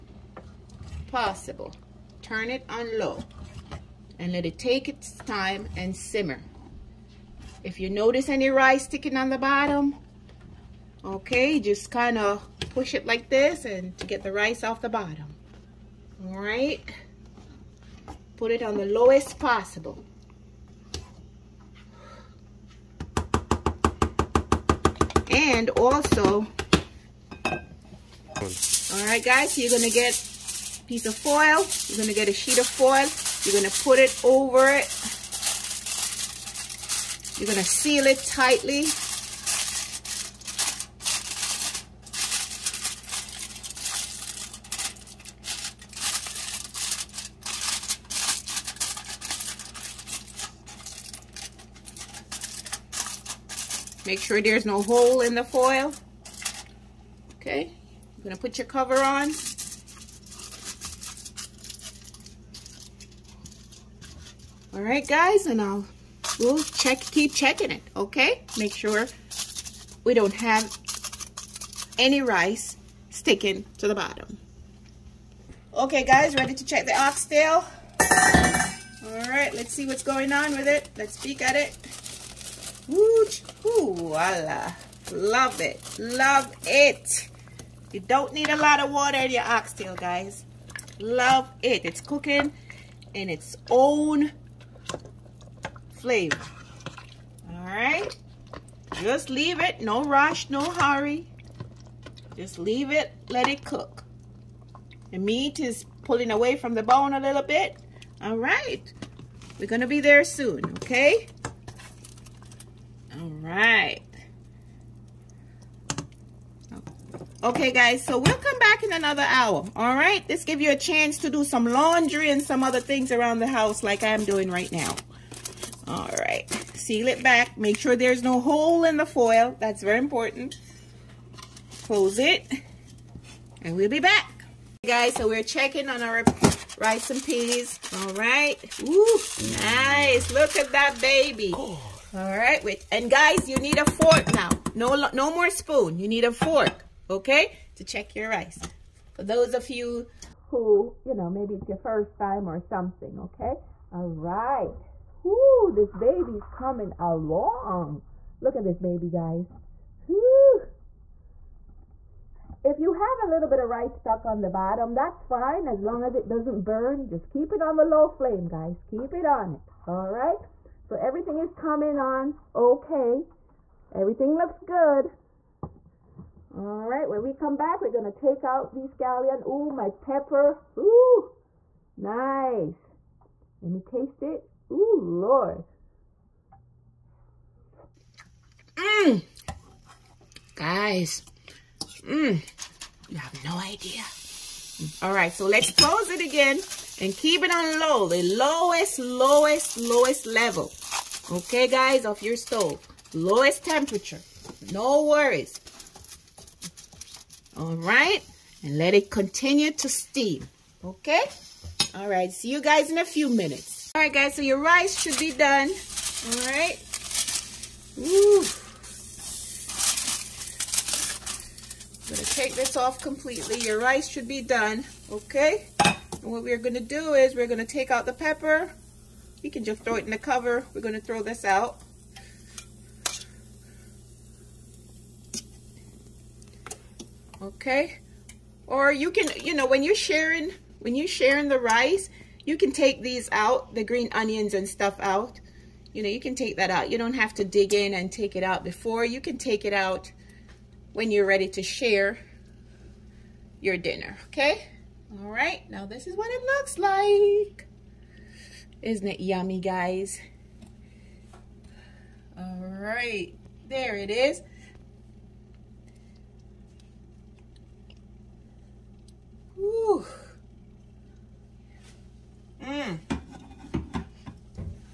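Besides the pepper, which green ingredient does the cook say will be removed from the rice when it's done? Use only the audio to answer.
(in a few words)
scallion.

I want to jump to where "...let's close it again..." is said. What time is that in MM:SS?
03:15.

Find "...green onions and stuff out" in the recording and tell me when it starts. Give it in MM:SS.
04:03.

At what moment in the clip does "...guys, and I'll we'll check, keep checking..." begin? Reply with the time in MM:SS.
01:05.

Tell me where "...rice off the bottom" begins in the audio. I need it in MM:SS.
00:14.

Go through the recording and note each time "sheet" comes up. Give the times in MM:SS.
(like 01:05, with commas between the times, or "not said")
00:32.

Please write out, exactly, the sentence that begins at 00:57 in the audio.
Okay, I'm gonna put your cover on.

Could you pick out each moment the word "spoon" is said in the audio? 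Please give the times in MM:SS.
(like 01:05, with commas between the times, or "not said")
02:25.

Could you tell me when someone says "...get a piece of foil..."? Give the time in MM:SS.
00:29.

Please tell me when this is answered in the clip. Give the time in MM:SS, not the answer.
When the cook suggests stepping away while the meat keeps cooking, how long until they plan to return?
01:58.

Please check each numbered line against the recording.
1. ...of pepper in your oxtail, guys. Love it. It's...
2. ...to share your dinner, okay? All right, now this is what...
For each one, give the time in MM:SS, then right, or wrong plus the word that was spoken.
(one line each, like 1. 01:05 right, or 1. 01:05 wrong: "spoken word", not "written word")
1. 01:28 wrong: "water", not "pepper"
2. 04:11 right.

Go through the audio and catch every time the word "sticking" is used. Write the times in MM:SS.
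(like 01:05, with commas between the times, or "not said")
00:08, 01:13.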